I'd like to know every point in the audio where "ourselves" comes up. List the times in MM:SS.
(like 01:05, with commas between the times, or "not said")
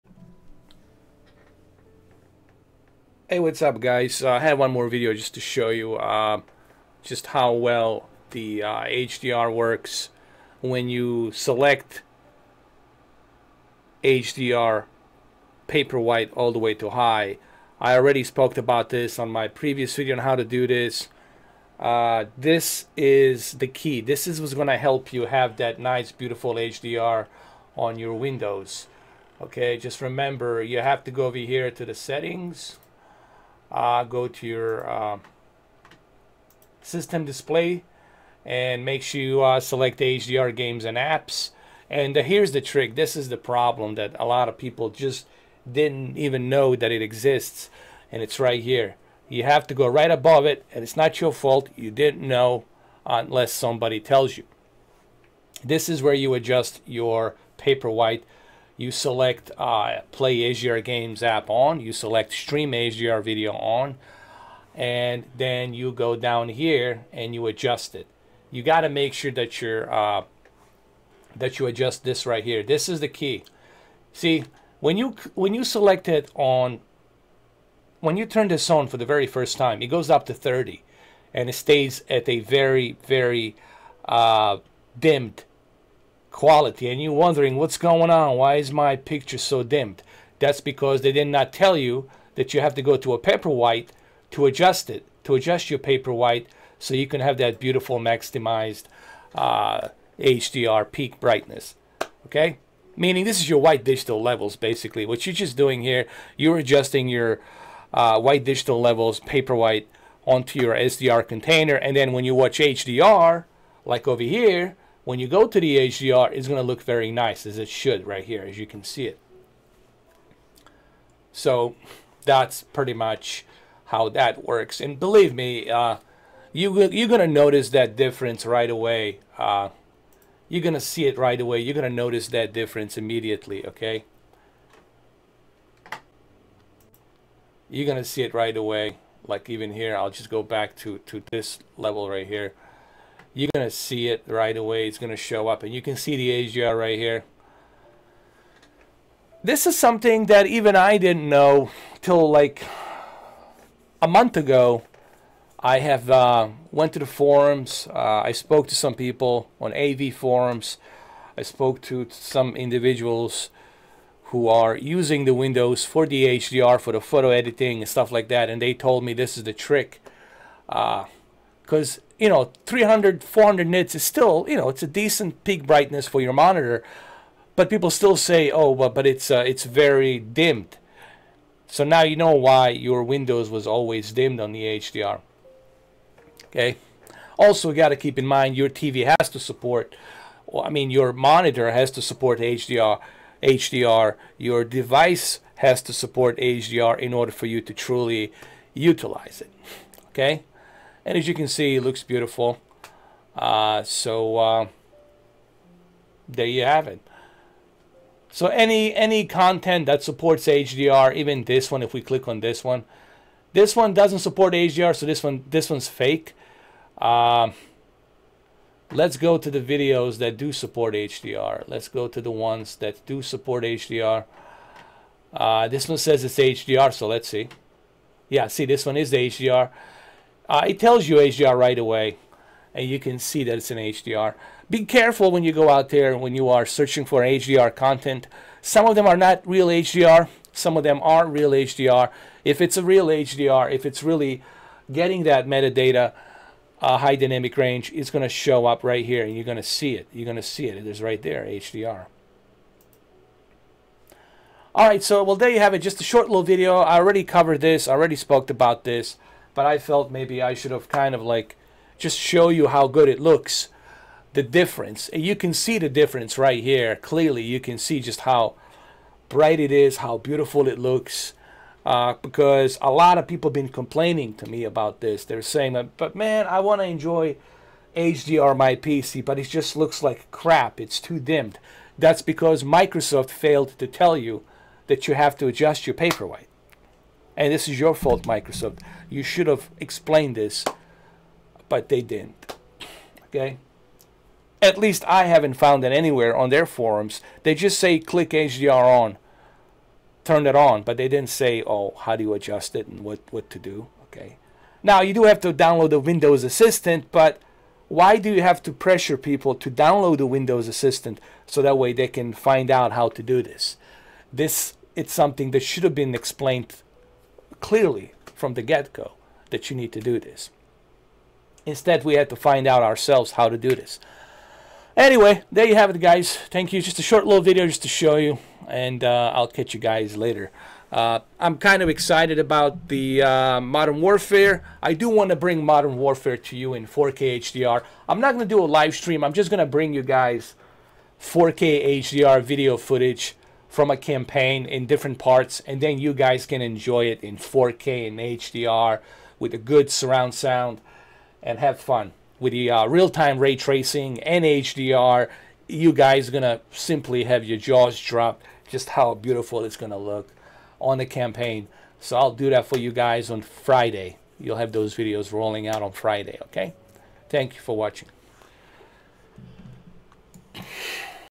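05:22.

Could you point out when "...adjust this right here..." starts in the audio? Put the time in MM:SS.
01:11.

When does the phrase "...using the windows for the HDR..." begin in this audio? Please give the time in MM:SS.
02:44.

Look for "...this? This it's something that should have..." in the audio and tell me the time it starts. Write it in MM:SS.
05:13.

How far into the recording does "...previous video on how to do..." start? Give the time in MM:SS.
00:19.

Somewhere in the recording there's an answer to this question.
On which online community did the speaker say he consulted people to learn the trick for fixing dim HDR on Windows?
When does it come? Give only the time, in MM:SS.
02:39.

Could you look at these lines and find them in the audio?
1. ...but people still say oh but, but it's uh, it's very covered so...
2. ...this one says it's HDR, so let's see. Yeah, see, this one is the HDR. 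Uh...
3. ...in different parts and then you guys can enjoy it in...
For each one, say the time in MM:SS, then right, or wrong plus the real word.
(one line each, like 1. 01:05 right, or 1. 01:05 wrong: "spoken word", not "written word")
1. 02:57 wrong: "dimmed", not "covered"
2. 03:45 right
3. 05:44 right.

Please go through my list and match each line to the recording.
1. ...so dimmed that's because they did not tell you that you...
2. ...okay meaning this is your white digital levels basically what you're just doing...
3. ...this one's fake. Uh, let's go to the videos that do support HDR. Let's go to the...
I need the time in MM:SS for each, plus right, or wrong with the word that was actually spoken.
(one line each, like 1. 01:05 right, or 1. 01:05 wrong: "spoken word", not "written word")
1. 01:29 right
2. 01:42 right
3. 03:35 right.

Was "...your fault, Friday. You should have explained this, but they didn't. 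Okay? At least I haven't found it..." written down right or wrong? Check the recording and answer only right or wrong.
wrong.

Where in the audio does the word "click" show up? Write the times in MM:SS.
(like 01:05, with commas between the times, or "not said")
03:32, 04:57.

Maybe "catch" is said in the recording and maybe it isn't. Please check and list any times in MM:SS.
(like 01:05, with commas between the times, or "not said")
05:29.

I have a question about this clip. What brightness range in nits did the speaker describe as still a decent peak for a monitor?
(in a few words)
300-400 nits.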